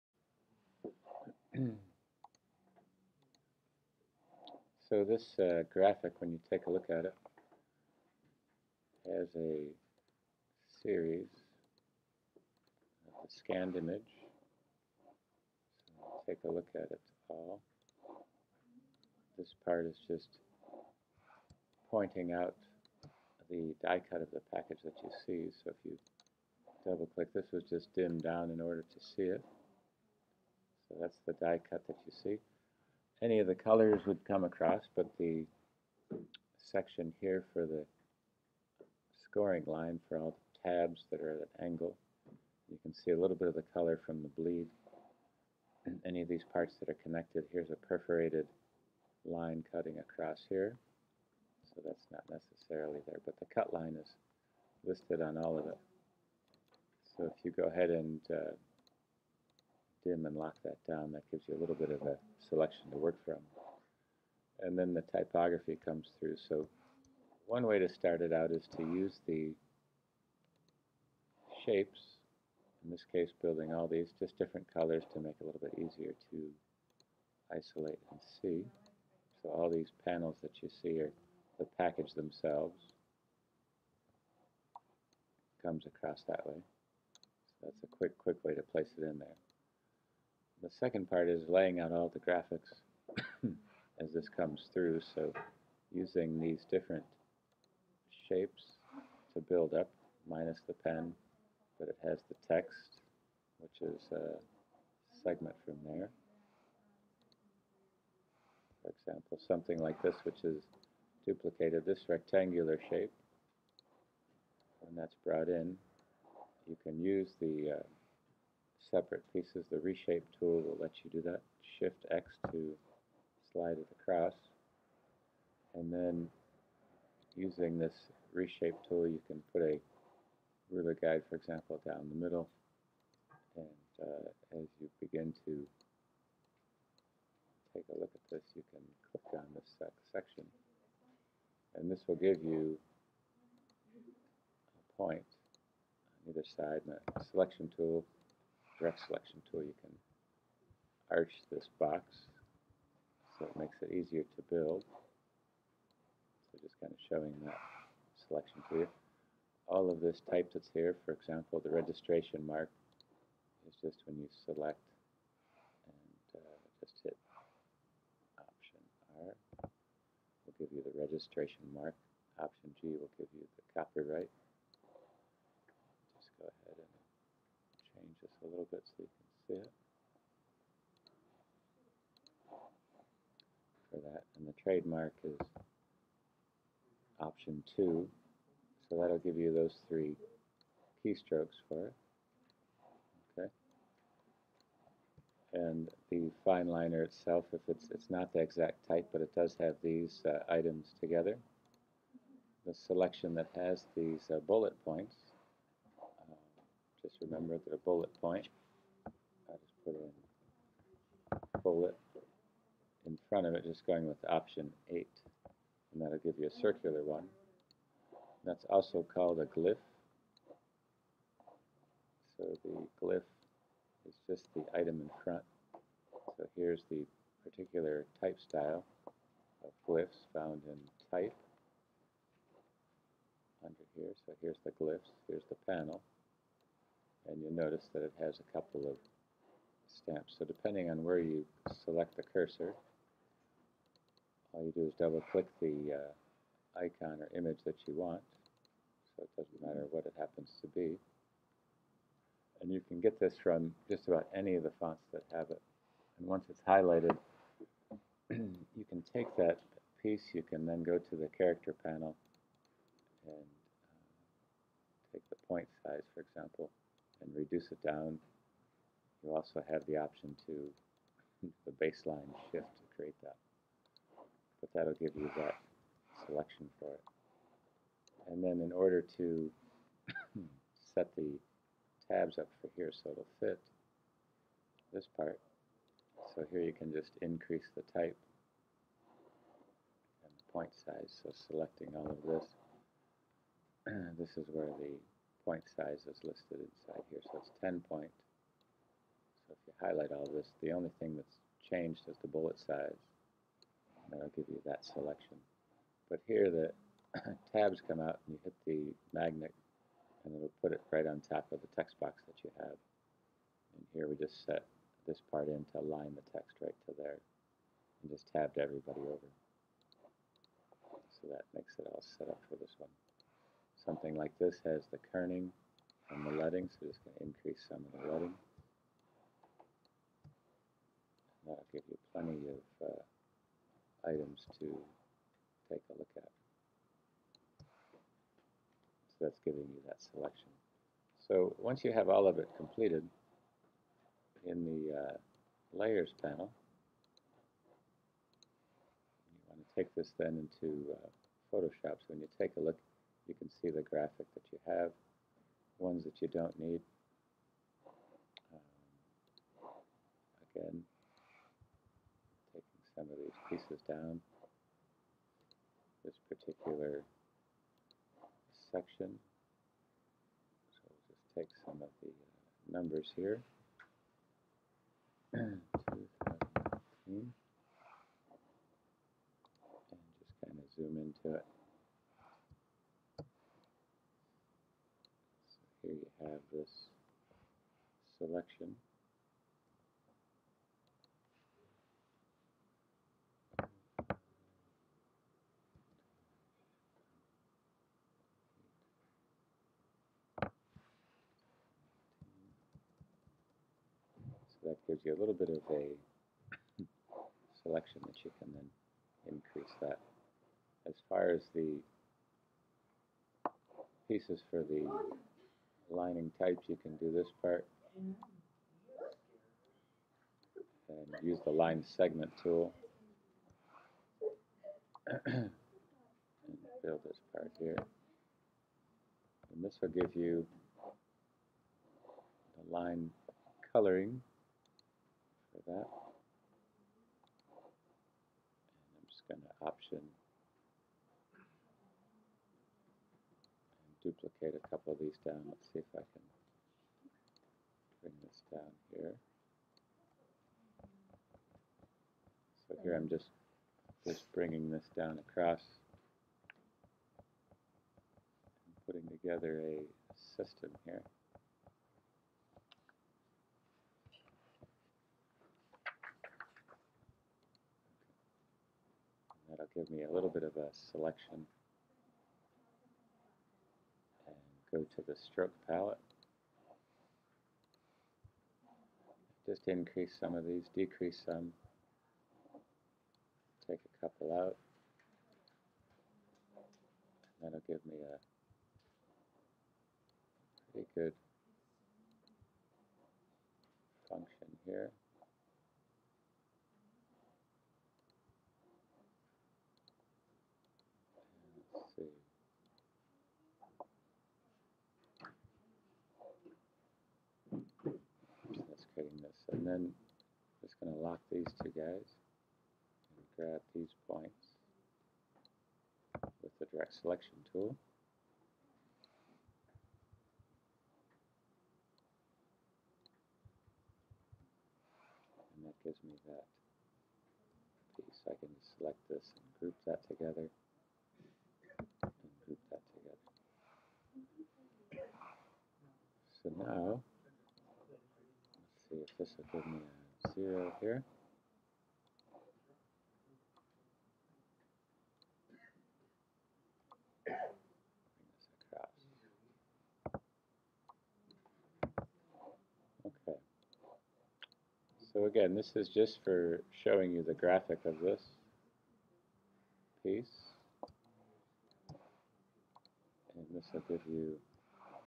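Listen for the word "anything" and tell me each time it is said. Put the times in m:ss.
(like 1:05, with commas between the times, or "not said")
not said.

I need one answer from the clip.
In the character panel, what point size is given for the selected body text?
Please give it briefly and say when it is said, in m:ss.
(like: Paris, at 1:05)
10 point, at 4:57.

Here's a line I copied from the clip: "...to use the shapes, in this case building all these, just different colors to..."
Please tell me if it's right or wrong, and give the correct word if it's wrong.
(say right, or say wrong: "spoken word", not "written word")
right.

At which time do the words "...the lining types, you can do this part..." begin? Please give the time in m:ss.
6:54.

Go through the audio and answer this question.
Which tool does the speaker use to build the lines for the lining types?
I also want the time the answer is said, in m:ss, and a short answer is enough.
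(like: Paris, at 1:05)
line segment tool, at 7:01.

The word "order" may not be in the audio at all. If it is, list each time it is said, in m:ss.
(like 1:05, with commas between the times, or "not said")
0:28, 4:38.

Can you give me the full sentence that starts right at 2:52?
Option G will give you the copyright.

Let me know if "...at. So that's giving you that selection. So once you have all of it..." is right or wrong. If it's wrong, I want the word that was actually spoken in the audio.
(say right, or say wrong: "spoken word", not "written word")
right.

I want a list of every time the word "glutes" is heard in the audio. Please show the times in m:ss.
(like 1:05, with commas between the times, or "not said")
not said.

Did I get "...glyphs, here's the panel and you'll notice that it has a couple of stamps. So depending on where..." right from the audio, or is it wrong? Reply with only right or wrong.
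right.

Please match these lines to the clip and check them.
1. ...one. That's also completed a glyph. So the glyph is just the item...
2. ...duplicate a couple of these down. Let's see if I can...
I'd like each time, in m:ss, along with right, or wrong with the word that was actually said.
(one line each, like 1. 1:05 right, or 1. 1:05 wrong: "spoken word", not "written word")
1. 3:37 wrong: "called", not "completed"
2. 7:24 right.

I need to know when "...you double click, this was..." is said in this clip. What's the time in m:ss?
0:25.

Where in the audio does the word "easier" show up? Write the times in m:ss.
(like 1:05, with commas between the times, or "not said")
1:15, 2:33.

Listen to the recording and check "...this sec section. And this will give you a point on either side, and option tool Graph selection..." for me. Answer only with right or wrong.
wrong.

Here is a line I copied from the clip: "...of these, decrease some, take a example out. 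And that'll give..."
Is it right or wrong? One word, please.
wrong.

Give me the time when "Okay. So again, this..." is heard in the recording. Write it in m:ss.
9:13.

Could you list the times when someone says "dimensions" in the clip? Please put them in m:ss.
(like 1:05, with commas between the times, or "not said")
not said.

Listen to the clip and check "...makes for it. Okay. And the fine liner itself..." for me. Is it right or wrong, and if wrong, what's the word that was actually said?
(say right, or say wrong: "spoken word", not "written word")
wrong: "keystrokes", not "makes".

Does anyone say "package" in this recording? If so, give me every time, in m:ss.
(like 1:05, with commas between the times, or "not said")
0:24, 1:21.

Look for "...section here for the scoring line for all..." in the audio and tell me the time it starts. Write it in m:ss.
0:36.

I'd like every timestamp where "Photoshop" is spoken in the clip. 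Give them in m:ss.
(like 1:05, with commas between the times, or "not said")
5:51.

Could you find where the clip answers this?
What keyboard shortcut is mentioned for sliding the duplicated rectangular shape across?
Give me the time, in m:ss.
2:01.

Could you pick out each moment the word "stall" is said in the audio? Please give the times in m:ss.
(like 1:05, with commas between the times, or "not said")
not said.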